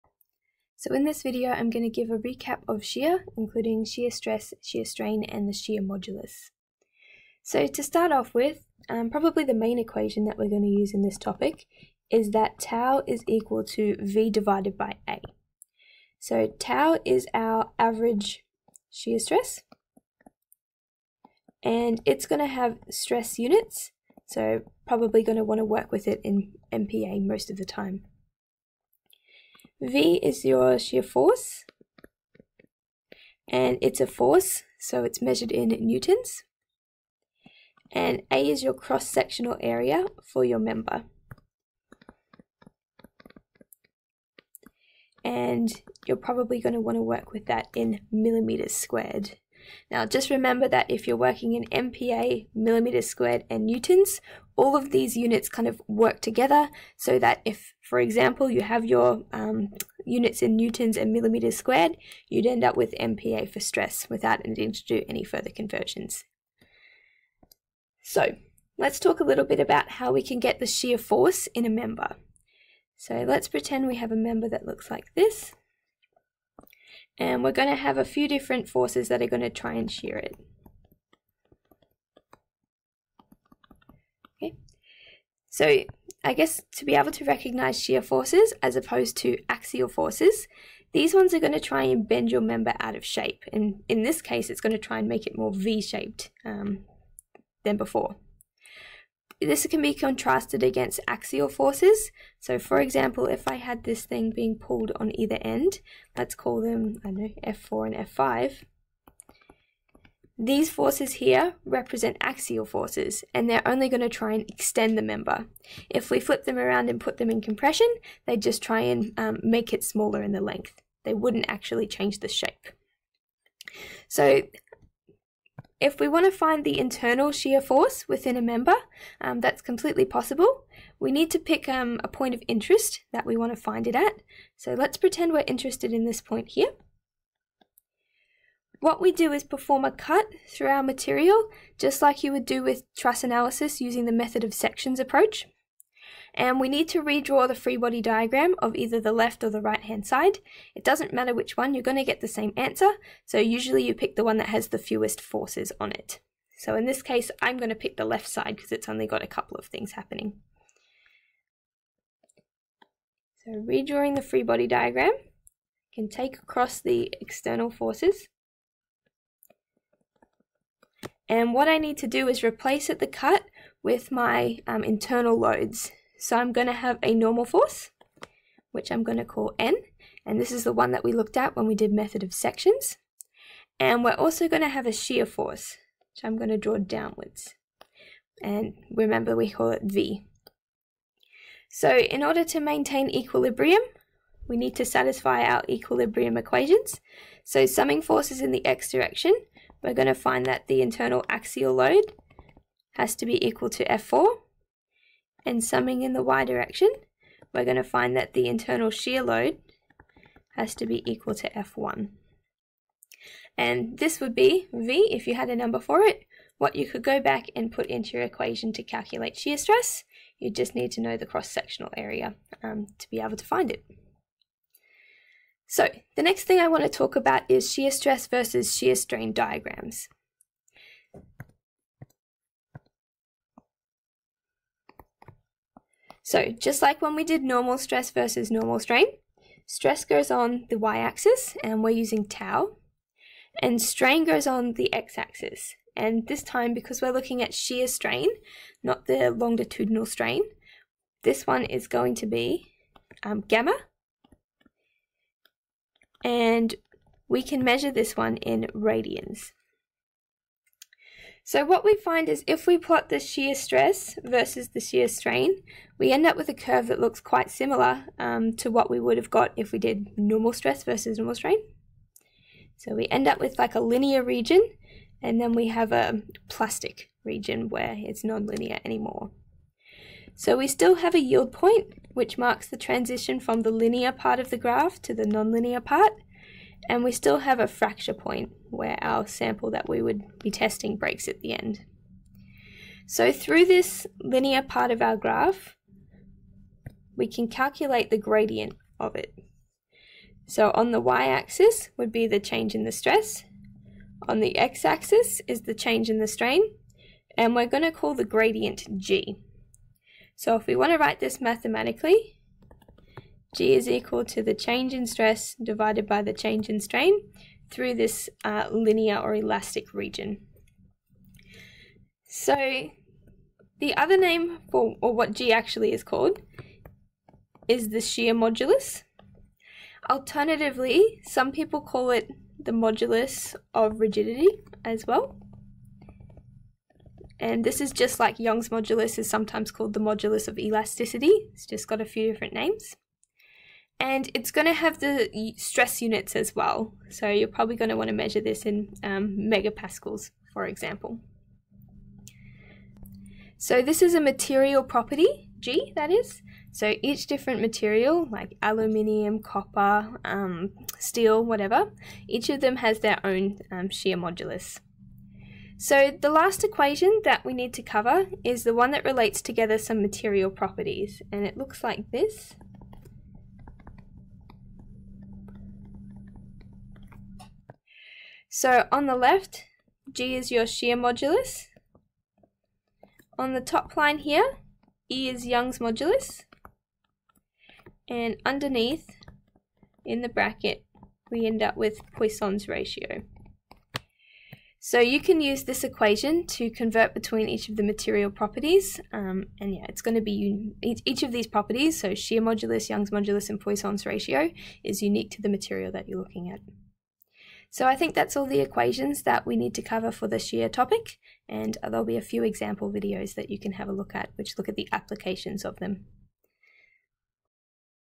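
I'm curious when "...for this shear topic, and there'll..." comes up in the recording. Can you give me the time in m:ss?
6:50.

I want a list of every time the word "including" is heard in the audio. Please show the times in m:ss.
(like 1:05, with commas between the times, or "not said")
0:03.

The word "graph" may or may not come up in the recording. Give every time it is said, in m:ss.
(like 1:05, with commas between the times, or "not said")
4:44, 4:55.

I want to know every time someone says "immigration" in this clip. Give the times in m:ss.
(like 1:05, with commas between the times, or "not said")
not said.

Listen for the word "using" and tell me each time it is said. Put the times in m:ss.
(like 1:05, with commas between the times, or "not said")
2:23, 4:01.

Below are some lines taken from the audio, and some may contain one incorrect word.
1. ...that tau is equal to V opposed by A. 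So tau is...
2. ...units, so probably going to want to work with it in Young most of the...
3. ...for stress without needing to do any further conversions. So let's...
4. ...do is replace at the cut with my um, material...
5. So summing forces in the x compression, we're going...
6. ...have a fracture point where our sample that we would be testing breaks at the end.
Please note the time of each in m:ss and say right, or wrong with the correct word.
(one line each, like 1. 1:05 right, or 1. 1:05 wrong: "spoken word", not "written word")
1. 0:12 wrong: "divided", not "opposed"
2. 0:23 wrong: "MPa", not "Young"
3. 1:03 right
4. 2:52 wrong: "internal", not "material"
5. 3:17 wrong: "direction", not "compression"
6. 4:47 right.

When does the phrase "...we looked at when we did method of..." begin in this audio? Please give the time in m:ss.
3:01.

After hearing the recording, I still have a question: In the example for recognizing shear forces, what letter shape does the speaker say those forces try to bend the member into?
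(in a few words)
V-shaped.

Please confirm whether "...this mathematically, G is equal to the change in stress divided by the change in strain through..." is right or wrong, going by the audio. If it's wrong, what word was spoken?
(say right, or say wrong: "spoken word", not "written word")
right.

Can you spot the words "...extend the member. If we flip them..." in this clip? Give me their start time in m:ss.
1:54.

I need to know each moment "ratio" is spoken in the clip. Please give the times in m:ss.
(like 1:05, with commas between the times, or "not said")
6:32, 6:44.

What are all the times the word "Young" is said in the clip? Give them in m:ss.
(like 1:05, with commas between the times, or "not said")
5:38, 6:25, 6:42.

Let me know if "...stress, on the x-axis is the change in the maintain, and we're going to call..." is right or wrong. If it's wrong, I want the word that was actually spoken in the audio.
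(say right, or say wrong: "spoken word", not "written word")
wrong: "strain", not "maintain".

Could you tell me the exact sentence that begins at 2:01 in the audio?
They wouldn't actually change the shape.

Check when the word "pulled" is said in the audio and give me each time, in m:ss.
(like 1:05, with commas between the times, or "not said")
1:44.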